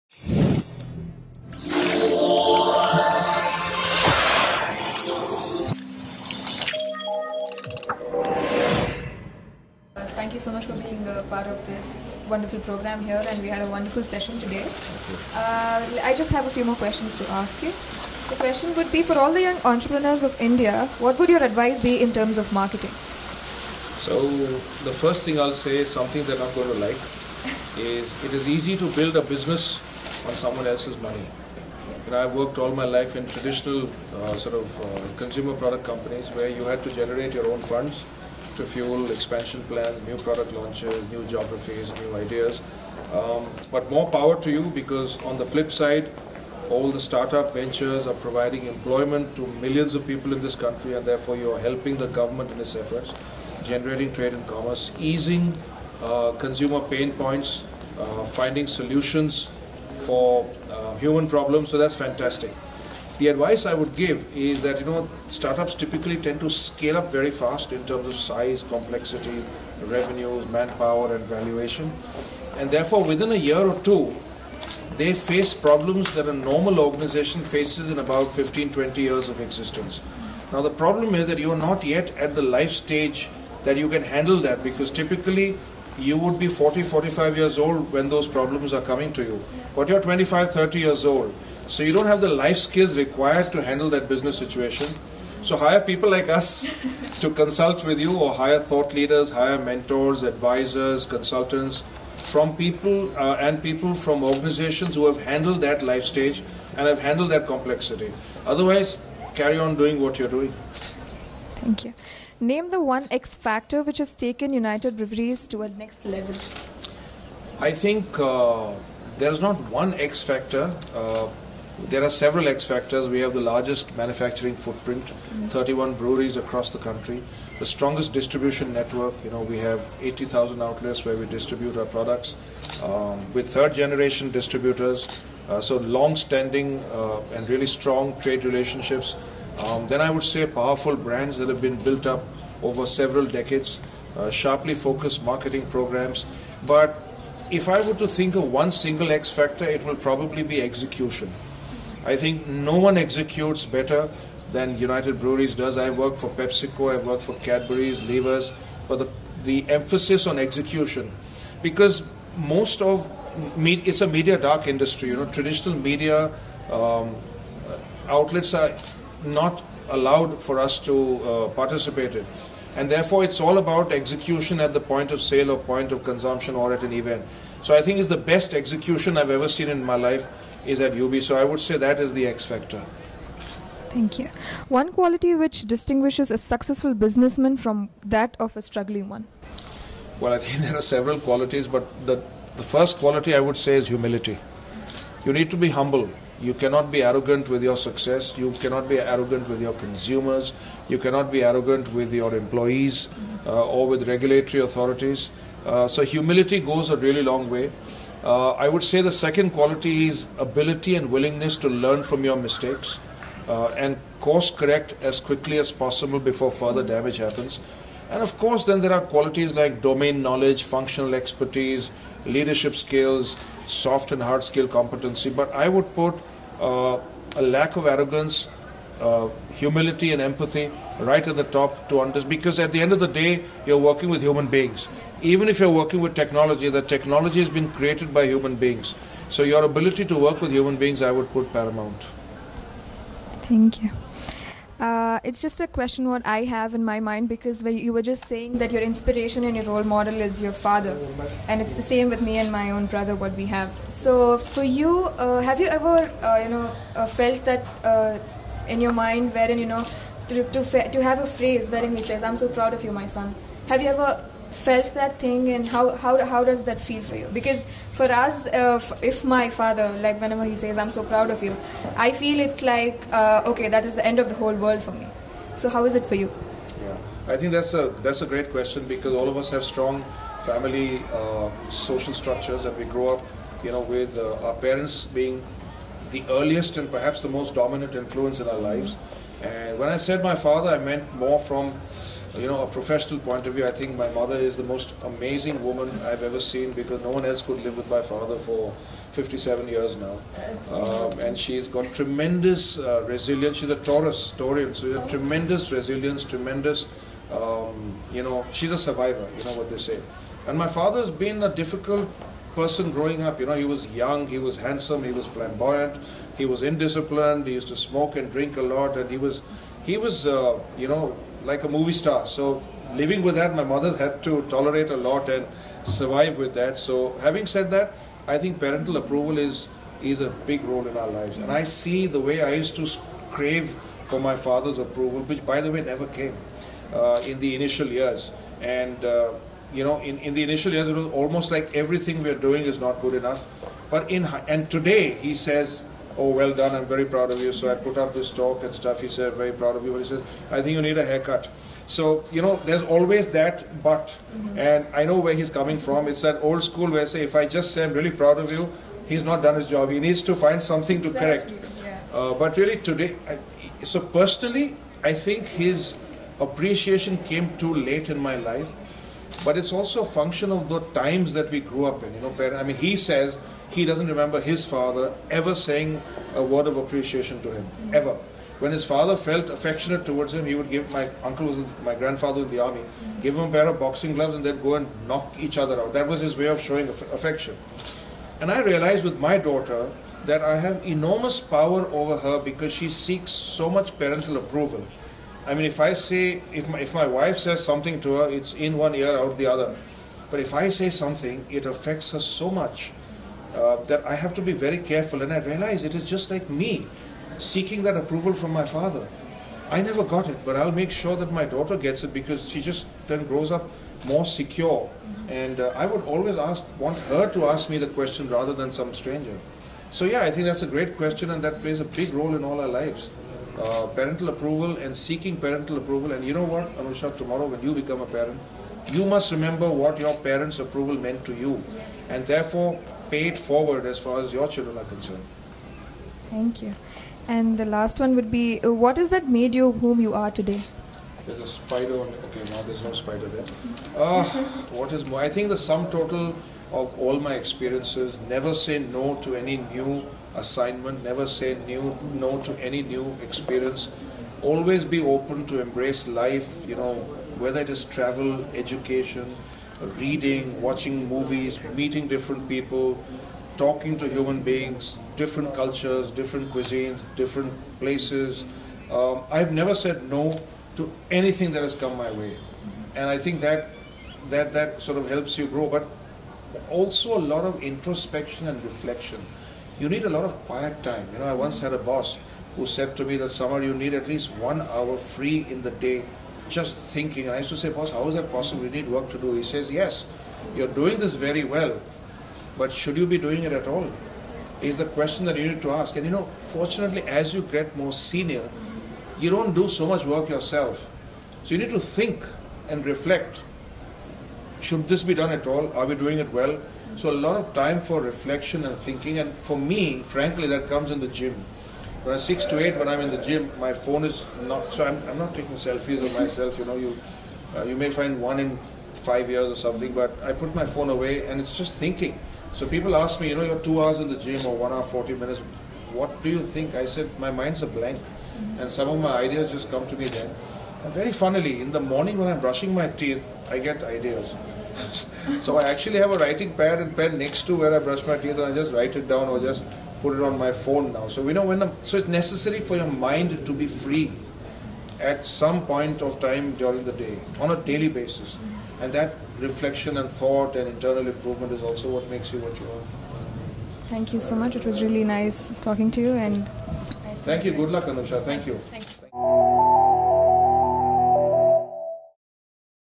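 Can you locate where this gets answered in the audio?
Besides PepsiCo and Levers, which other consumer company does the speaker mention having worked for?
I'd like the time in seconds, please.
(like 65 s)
157 s.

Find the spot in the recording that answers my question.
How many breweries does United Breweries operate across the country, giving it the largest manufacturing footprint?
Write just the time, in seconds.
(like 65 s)
125 s.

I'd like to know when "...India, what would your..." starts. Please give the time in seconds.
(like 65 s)
20 s.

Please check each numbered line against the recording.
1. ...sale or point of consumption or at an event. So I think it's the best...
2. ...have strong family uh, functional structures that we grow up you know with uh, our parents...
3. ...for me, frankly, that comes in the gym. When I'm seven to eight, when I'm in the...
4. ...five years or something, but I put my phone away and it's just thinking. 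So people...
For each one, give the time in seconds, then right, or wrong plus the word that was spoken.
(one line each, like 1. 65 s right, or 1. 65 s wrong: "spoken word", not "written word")
1. 175 s right
2. 279 s wrong: "social", not "functional"
3. 509 s wrong: "six", not "seven"
4. 519 s right.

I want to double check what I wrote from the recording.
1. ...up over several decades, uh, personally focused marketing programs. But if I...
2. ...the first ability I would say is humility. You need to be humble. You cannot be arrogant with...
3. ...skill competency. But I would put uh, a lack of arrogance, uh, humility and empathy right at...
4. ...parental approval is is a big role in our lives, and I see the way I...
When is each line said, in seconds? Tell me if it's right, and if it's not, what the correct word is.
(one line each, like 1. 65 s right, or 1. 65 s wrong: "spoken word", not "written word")
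1. 142 s wrong: "sharply", not "personally"
2. 192 s wrong: "quality", not "ability"
3. 224 s right
4. 328 s right.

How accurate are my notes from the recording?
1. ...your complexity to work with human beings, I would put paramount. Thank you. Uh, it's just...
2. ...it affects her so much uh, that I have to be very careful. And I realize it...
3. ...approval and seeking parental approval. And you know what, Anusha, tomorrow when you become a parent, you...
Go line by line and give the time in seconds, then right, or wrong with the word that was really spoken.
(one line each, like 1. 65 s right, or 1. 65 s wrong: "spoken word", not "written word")
1. 239 s wrong: "ability", not "complexity"
2. 401 s right
3. 424 s right.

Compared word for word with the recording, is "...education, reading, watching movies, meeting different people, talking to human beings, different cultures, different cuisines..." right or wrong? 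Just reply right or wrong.
right.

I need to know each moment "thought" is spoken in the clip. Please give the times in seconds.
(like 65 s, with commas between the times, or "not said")
98 s, 550 s.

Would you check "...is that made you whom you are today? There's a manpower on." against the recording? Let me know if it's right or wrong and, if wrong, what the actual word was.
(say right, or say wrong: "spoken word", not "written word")
wrong: "spider", not "manpower".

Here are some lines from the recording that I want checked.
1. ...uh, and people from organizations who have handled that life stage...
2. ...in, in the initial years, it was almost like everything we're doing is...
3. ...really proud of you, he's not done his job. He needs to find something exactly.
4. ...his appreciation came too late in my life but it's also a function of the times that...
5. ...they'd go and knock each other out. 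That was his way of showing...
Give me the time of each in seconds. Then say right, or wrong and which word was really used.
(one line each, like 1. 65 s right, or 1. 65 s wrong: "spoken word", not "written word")
1. 103 s right
2. 340 s right
3. 357 s right
4. 365 s right
5. 384 s right.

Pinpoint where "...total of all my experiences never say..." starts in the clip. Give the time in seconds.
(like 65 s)
445 s.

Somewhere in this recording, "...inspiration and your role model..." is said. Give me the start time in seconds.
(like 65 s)
248 s.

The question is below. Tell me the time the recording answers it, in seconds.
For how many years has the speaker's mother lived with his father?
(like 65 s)
299 s.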